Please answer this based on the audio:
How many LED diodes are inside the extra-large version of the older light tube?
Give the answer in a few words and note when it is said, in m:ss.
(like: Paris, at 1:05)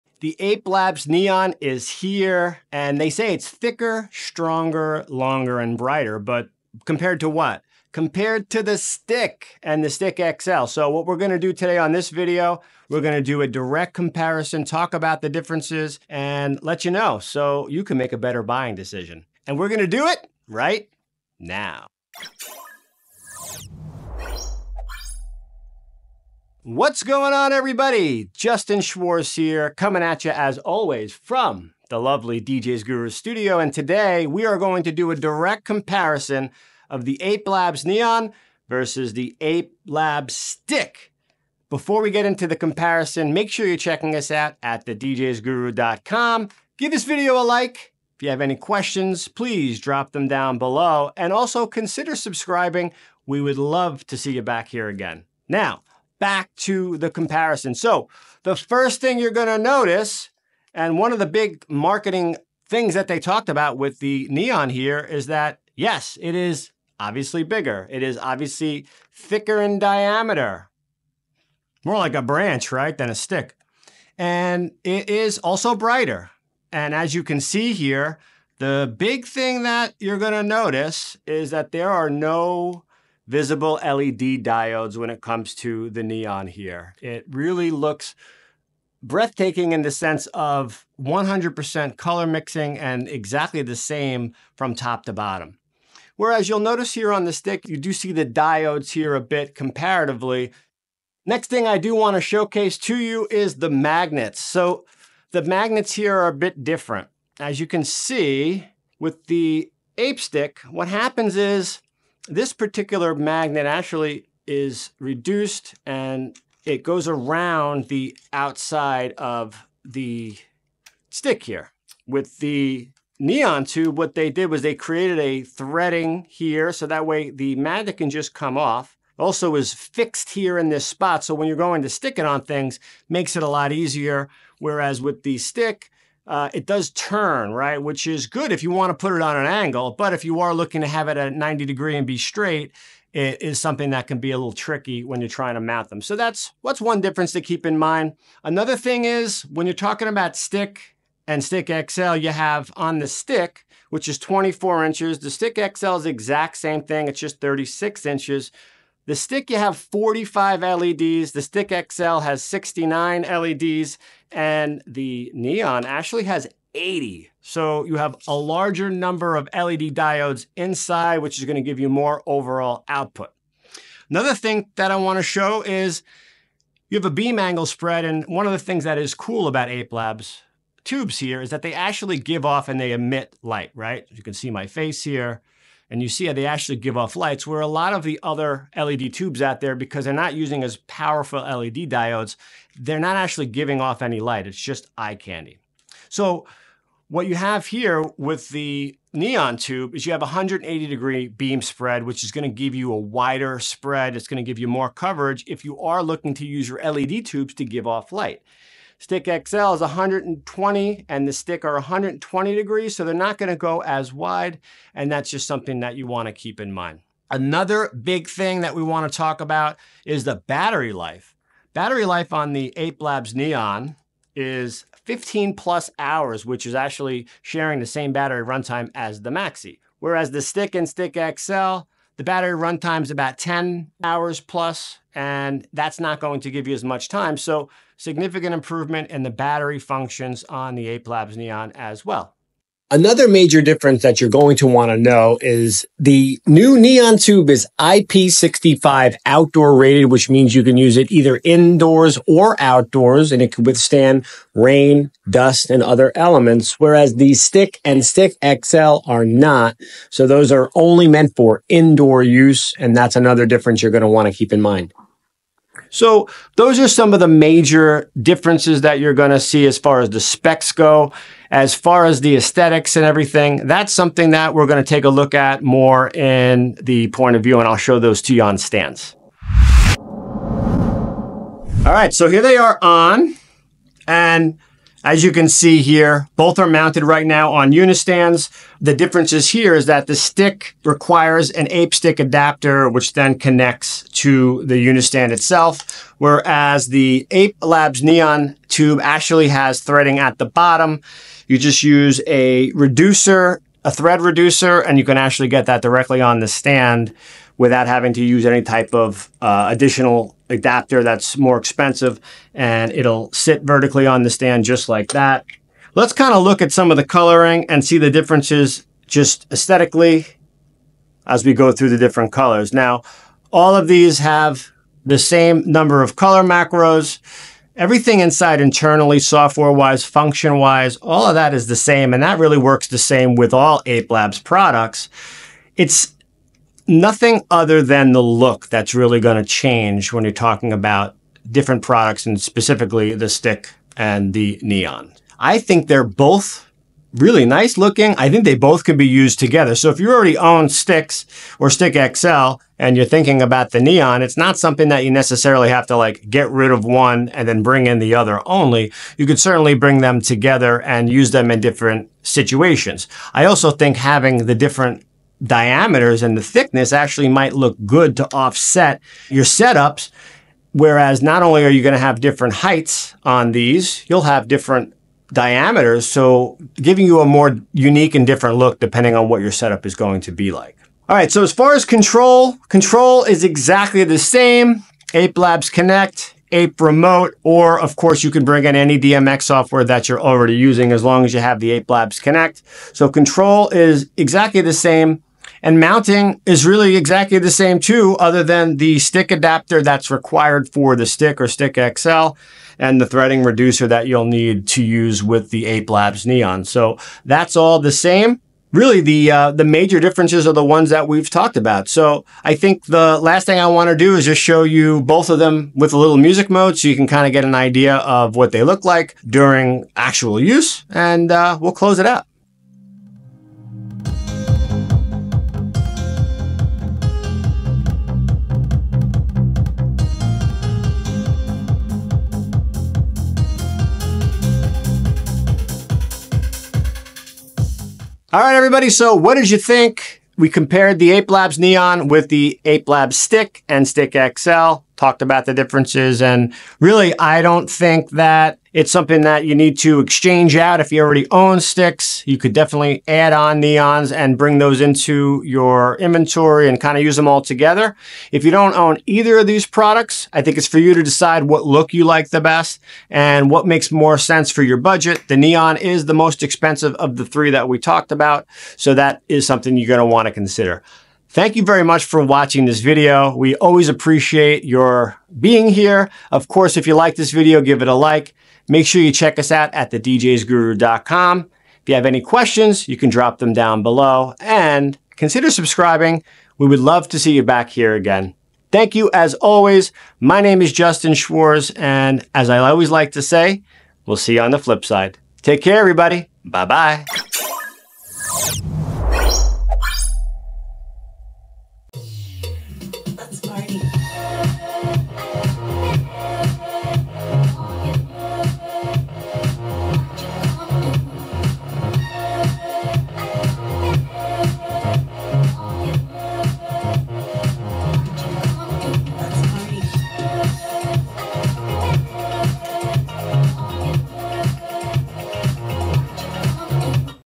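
69, at 2:42.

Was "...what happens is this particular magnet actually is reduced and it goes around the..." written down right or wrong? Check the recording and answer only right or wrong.
right.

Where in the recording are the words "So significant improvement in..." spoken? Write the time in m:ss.
3:57.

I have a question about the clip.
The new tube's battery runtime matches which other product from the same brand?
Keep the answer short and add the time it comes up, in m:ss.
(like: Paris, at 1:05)
Maxi, at 3:49.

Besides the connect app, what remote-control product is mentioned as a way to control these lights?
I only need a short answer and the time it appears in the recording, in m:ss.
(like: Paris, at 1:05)
Ape Remote, at 6:26.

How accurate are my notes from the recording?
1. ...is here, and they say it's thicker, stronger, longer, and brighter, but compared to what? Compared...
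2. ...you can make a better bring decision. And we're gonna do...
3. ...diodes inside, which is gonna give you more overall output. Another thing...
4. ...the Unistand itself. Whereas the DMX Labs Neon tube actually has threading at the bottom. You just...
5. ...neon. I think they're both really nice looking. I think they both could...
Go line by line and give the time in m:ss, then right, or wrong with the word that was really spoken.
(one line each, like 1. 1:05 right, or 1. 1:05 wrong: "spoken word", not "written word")
1. 0:01 right
2. 0:17 wrong: "buying", not "bring"
3. 2:49 right
4. 4:54 wrong: "Ape", not "DMX"
5. 5:44 right.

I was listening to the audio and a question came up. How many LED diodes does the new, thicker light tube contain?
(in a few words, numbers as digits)
80.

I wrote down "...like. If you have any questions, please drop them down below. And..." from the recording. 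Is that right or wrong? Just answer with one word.
right.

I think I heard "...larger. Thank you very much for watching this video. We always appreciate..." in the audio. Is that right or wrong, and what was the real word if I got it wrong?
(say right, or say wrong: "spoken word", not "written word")
wrong: "consider", not "larger".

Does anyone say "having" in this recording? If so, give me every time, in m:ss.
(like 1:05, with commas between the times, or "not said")
5:07, 6:03.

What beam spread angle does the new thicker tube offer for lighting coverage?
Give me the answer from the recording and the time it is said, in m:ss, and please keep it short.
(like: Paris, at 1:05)
180 degrees, at 3:20.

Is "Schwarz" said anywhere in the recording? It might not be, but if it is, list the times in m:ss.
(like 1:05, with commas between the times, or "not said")
0:28, 8:11.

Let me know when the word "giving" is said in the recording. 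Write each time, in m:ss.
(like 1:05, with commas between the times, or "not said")
3:13, 6:16.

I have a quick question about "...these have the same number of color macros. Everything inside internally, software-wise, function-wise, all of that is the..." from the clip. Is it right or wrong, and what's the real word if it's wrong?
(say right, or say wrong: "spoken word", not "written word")
right.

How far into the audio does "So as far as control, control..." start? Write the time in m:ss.
6:21.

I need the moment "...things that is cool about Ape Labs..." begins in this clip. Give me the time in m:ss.
2:58.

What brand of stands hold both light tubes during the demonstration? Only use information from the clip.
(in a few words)
Unistands.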